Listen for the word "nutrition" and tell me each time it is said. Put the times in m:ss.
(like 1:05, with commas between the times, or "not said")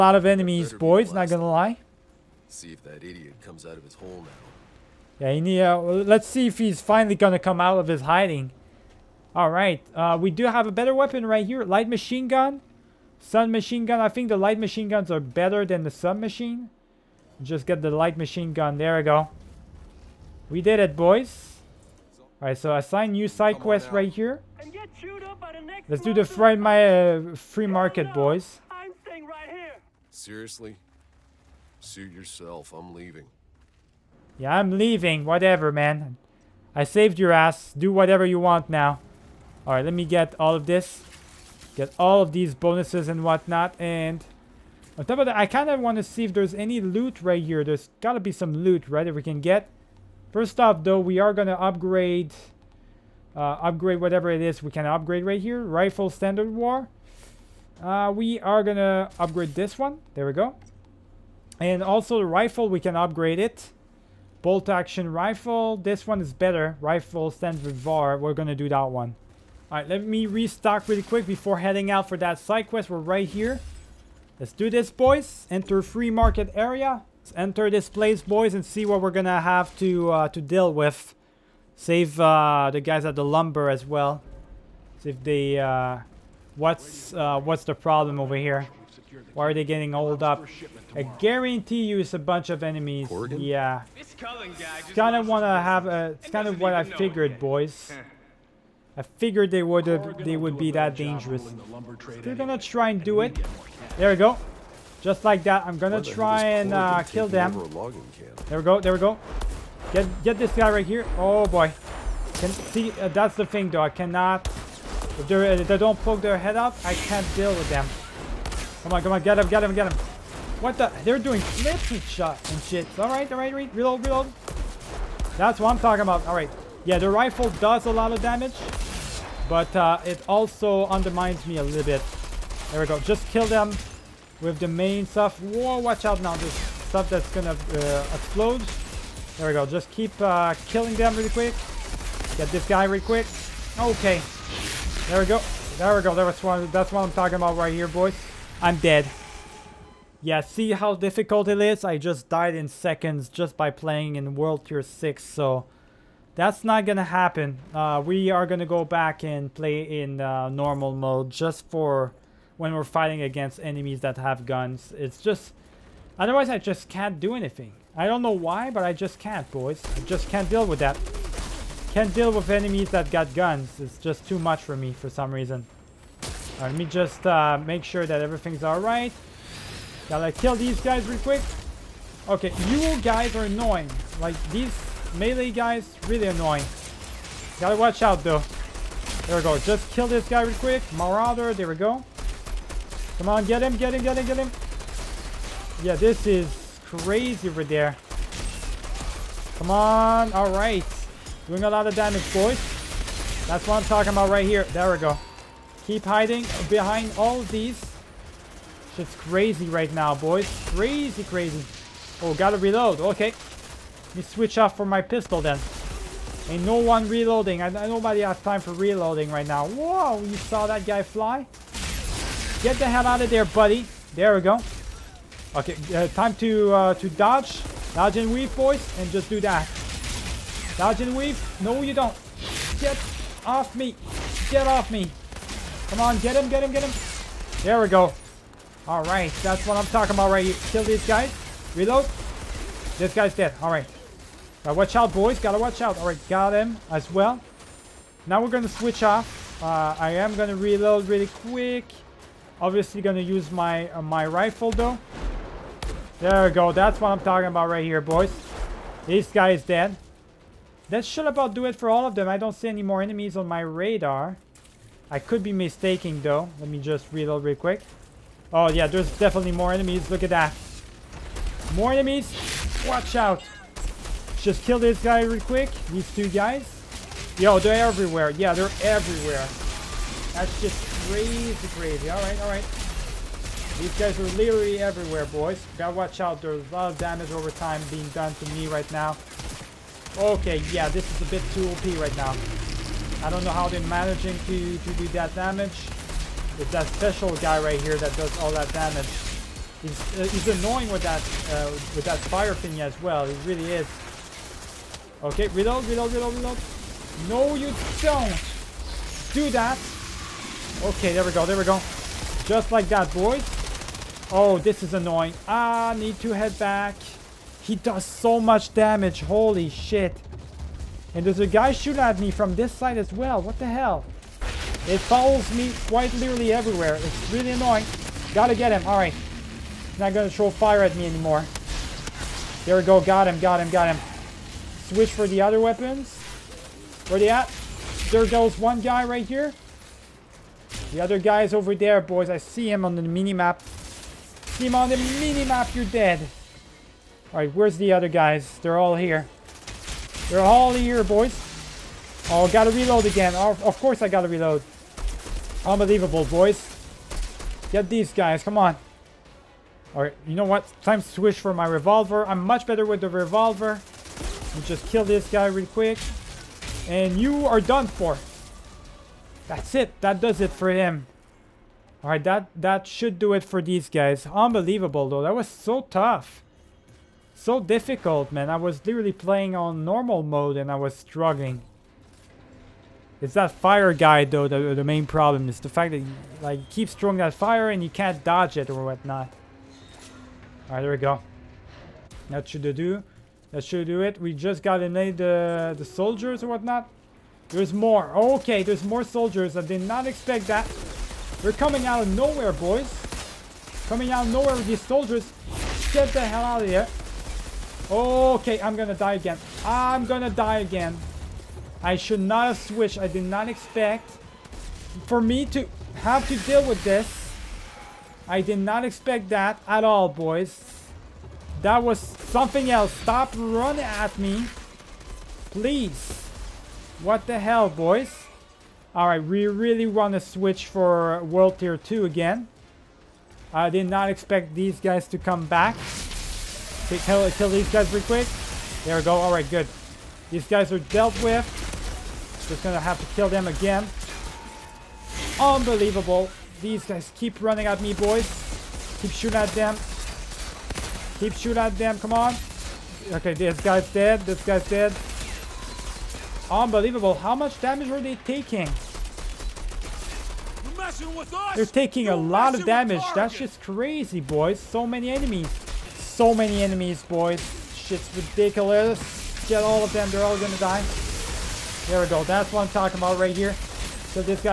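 not said.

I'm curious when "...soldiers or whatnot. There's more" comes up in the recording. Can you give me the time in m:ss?
6:35.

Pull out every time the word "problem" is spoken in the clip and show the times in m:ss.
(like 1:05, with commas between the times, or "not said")
1:27, 6:25.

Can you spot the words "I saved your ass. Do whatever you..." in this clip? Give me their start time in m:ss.
0:36.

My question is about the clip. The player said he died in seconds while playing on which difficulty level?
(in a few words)
World Tier 6.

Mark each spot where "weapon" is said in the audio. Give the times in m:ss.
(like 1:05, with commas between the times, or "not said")
0:10, 5:35.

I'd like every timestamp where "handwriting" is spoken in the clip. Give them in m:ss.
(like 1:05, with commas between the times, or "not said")
not said.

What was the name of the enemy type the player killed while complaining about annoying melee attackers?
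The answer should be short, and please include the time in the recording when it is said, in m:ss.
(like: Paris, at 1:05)
Marauder, at 3:10.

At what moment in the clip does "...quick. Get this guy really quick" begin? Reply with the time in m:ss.
2:21.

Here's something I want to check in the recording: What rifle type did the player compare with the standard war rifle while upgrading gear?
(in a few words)
Bolt action rifle.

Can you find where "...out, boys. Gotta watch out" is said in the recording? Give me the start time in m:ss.
4:04.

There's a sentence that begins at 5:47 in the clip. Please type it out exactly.
All right, where's the other guys?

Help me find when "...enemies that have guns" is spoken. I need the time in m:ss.
2:43.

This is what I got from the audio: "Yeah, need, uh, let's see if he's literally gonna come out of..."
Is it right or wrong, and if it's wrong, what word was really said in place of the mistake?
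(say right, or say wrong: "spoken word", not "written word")
wrong: "finally", not "literally".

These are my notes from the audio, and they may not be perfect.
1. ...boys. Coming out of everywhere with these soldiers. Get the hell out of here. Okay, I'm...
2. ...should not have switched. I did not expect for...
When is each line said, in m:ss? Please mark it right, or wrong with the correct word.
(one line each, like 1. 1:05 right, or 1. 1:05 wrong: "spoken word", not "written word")
1. 6:42 wrong: "nowhere", not "everywhere"
2. 6:51 right.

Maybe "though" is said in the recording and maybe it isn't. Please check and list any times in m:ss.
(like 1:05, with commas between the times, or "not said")
0:50, 1:53, 3:08, 4:14, 4:26, 6:15, 6:24.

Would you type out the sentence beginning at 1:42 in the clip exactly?
They're gonna try and do it.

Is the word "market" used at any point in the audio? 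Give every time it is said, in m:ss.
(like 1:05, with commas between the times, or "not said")
0:27, 1:16.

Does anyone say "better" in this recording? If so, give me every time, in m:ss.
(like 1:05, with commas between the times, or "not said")
0:10, 0:15, 1:06, 6:02.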